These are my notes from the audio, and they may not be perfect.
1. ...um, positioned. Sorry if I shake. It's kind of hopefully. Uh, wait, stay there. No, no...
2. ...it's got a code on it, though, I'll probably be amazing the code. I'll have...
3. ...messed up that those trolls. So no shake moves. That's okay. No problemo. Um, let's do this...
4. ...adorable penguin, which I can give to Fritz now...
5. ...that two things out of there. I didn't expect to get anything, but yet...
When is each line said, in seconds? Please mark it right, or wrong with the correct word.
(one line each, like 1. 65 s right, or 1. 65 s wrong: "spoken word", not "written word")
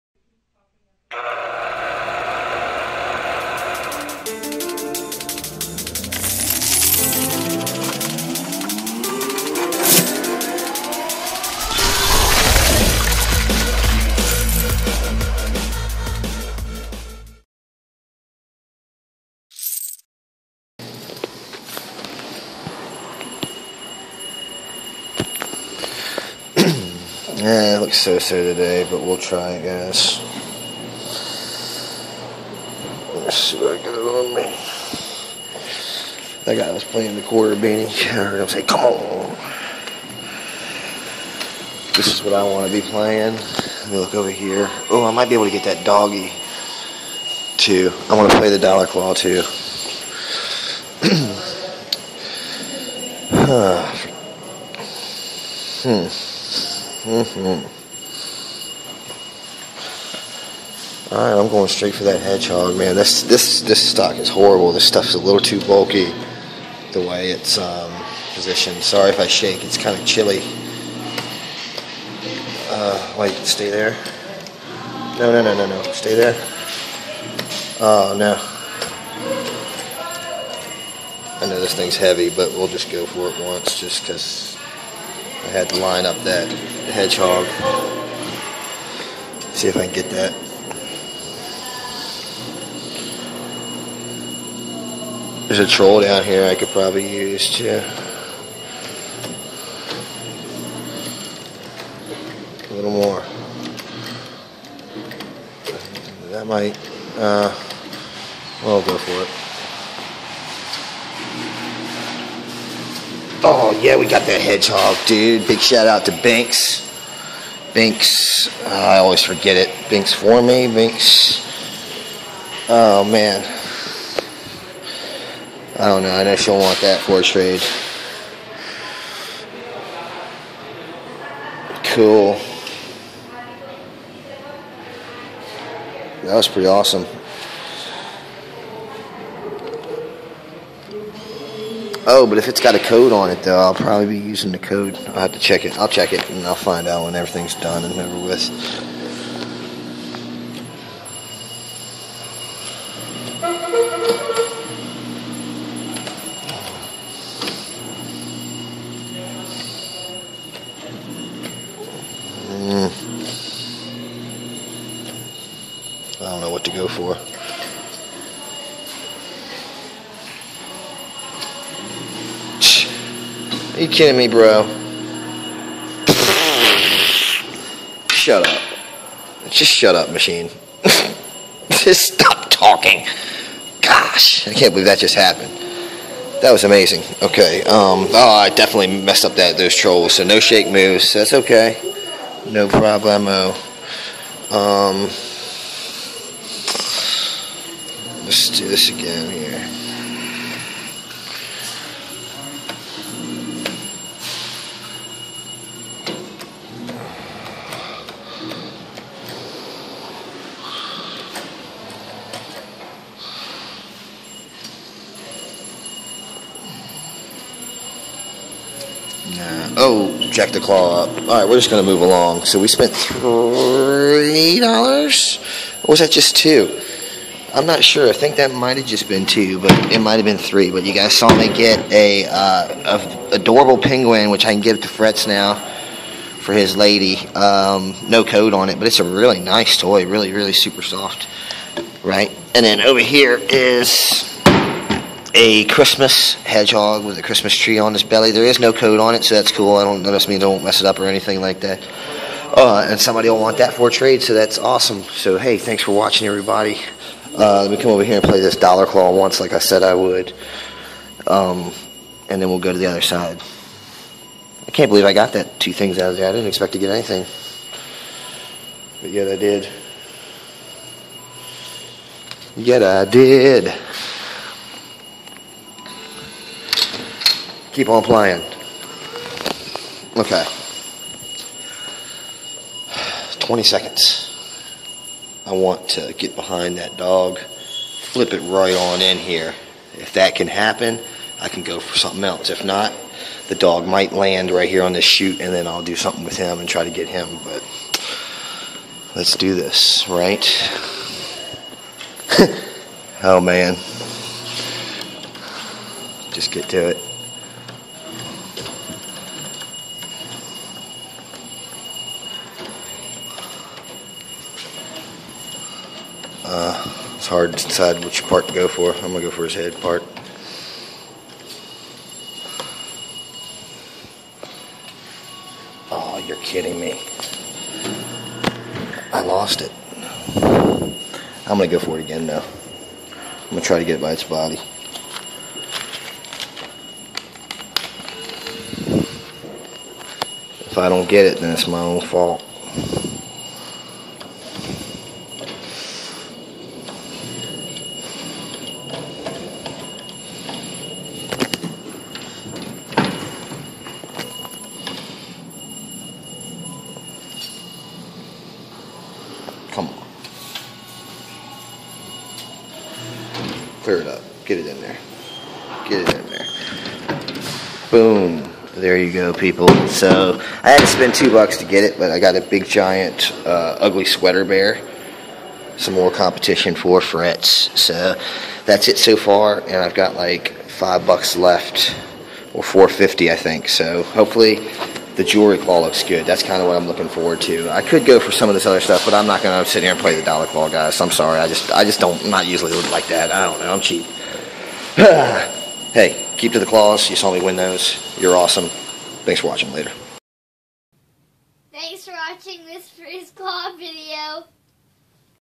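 1. 67 s wrong: "chilly", not "hopefully"
2. 142 s wrong: "using", not "amazing"
3. 189 s right
4. 233 s right
5. 265 s right.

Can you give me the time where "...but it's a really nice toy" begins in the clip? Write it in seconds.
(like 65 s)
238 s.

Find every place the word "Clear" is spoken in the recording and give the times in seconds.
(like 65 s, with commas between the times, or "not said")
363 s.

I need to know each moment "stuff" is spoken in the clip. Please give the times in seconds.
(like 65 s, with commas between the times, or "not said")
64 s, 388 s.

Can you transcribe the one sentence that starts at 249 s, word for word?
I don't notice me don't mess it up or anything like that.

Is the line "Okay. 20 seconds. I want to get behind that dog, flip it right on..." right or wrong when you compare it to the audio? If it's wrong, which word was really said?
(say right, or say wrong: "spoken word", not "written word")
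right.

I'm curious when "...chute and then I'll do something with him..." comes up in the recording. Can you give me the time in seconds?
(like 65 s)
295 s.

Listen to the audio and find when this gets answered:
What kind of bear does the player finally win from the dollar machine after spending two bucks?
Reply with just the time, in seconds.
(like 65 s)
373 s.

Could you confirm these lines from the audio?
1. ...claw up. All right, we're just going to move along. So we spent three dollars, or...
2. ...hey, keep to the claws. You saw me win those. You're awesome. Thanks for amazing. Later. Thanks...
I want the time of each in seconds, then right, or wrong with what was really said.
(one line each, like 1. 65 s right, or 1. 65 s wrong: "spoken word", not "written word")
1. 220 s right
2. 395 s wrong: "watching", not "amazing".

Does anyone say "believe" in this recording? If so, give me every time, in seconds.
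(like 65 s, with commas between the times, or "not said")
184 s, 264 s.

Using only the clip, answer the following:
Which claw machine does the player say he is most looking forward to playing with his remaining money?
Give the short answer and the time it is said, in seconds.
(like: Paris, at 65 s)
Jewelry claw, at 385 s.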